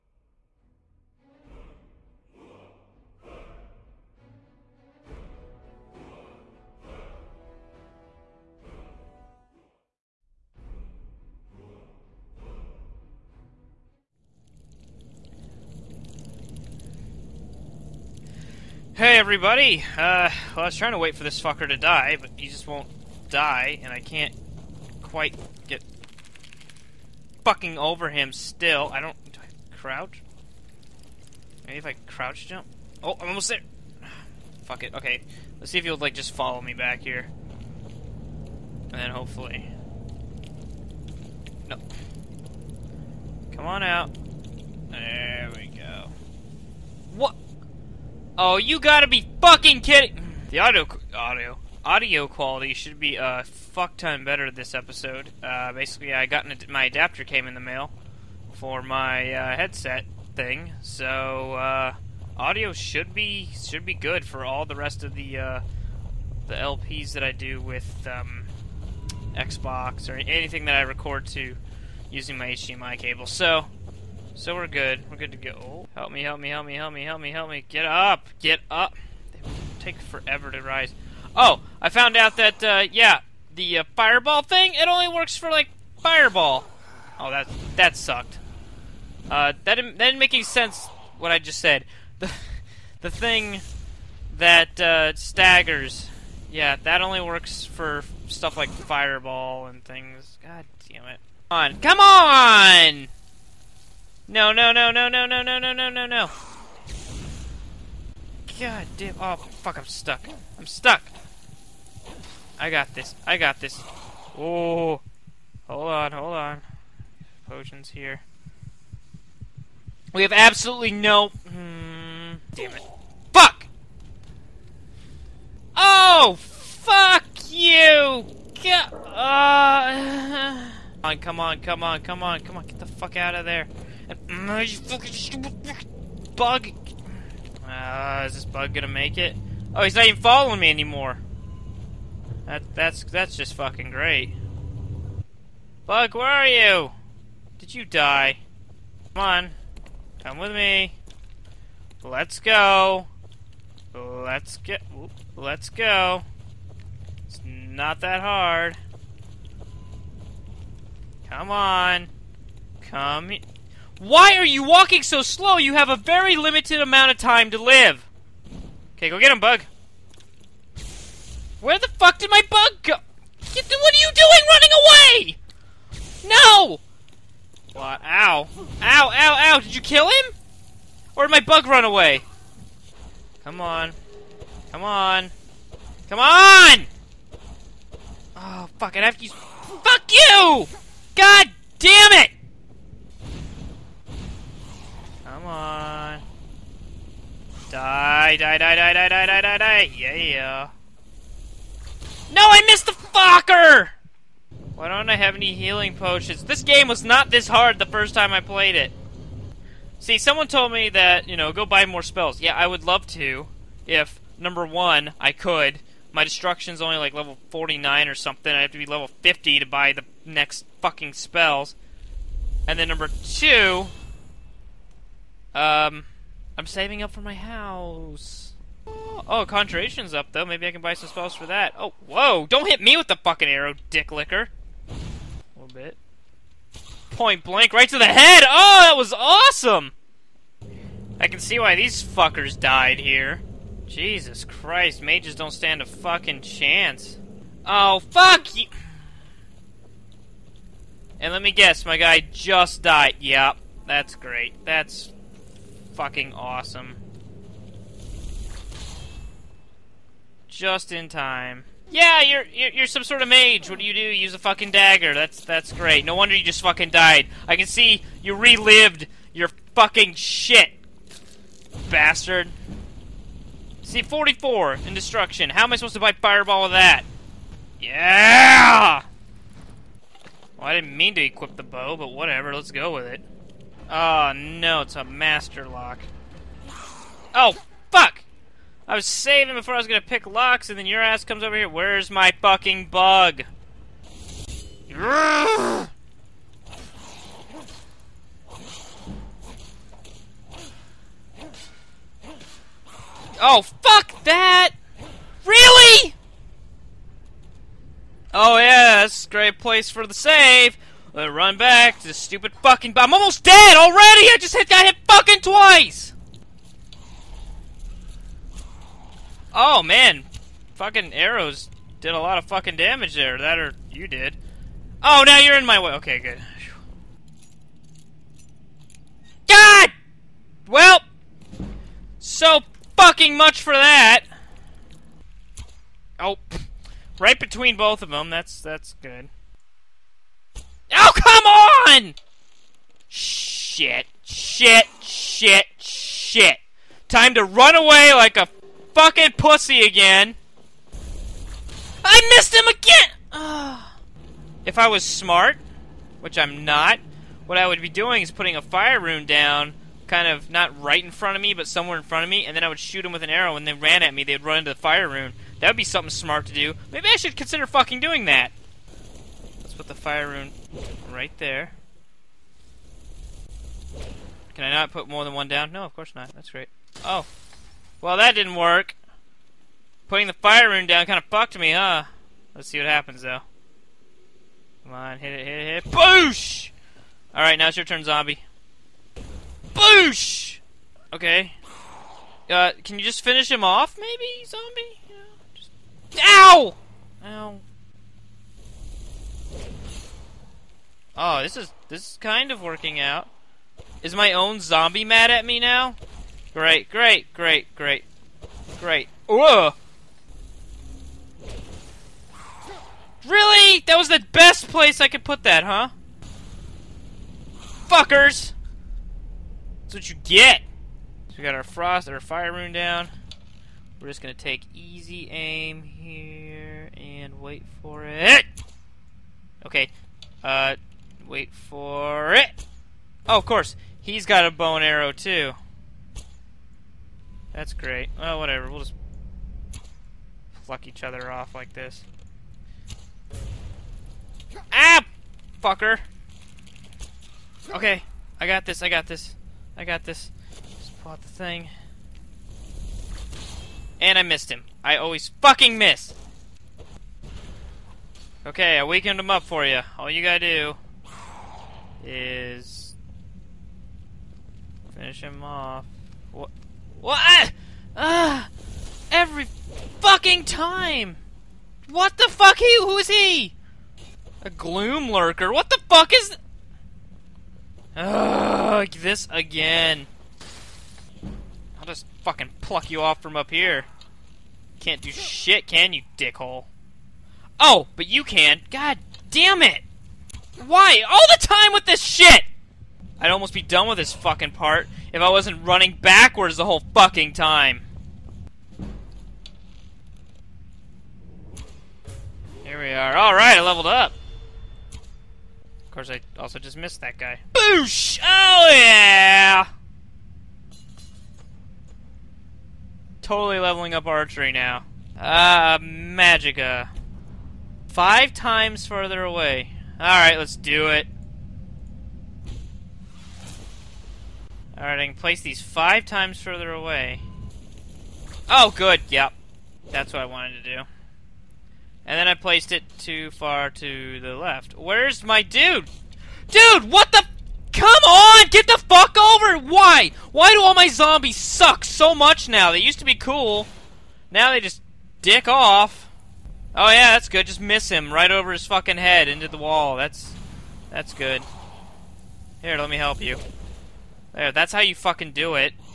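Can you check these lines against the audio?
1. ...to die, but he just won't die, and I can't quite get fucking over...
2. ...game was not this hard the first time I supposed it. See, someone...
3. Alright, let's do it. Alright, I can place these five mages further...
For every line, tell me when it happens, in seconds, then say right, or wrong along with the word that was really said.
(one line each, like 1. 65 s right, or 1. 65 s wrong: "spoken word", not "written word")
1. 21 s right
2. 206 s wrong: "played", not "supposed"
3. 519 s wrong: "times", not "mages".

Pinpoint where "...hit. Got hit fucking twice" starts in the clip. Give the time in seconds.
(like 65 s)
314 s.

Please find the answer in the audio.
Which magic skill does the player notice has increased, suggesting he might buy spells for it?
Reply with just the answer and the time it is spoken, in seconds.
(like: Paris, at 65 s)
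Conjuration, at 229 s.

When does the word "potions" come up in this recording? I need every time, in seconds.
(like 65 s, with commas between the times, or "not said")
117 s, 205 s.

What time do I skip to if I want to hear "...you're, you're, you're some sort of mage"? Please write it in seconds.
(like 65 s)
262 s.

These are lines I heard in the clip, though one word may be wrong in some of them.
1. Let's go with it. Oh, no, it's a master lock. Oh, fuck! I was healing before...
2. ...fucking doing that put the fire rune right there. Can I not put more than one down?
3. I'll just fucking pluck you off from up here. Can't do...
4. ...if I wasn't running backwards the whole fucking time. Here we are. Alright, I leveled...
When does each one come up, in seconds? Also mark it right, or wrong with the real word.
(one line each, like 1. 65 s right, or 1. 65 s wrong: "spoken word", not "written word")
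1. 282 s wrong: "saving", not "healing"
2. 367 s right
3. 481 s right
4. 495 s right.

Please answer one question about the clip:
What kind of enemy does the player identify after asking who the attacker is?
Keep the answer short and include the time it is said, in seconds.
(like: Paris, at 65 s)
gloom lurker, at 474 s.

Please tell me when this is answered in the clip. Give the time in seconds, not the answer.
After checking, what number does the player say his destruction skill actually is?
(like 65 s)
273 s.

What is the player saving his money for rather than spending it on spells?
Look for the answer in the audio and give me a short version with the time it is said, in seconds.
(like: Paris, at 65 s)
my house, at 226 s.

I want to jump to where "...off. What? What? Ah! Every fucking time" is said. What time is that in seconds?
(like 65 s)
465 s.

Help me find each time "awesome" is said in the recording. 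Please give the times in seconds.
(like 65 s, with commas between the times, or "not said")
239 s, 256 s.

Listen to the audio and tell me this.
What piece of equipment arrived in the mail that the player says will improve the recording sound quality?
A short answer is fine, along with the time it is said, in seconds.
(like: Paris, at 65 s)
adapter, at 56 s.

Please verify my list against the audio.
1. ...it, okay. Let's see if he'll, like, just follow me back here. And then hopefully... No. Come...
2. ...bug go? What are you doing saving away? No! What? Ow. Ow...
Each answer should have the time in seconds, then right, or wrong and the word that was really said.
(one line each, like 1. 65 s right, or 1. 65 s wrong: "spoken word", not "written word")
1. 34 s right
2. 172 s wrong: "running", not "saving".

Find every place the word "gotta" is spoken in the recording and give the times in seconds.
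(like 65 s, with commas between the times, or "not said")
48 s, 460 s.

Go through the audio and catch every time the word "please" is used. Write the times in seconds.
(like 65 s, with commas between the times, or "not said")
not said.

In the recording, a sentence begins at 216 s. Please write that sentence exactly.
My destruction's only like level 49 or something.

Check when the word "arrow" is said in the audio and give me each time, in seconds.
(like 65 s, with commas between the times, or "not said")
233 s, 321 s, 363 s, 434 s.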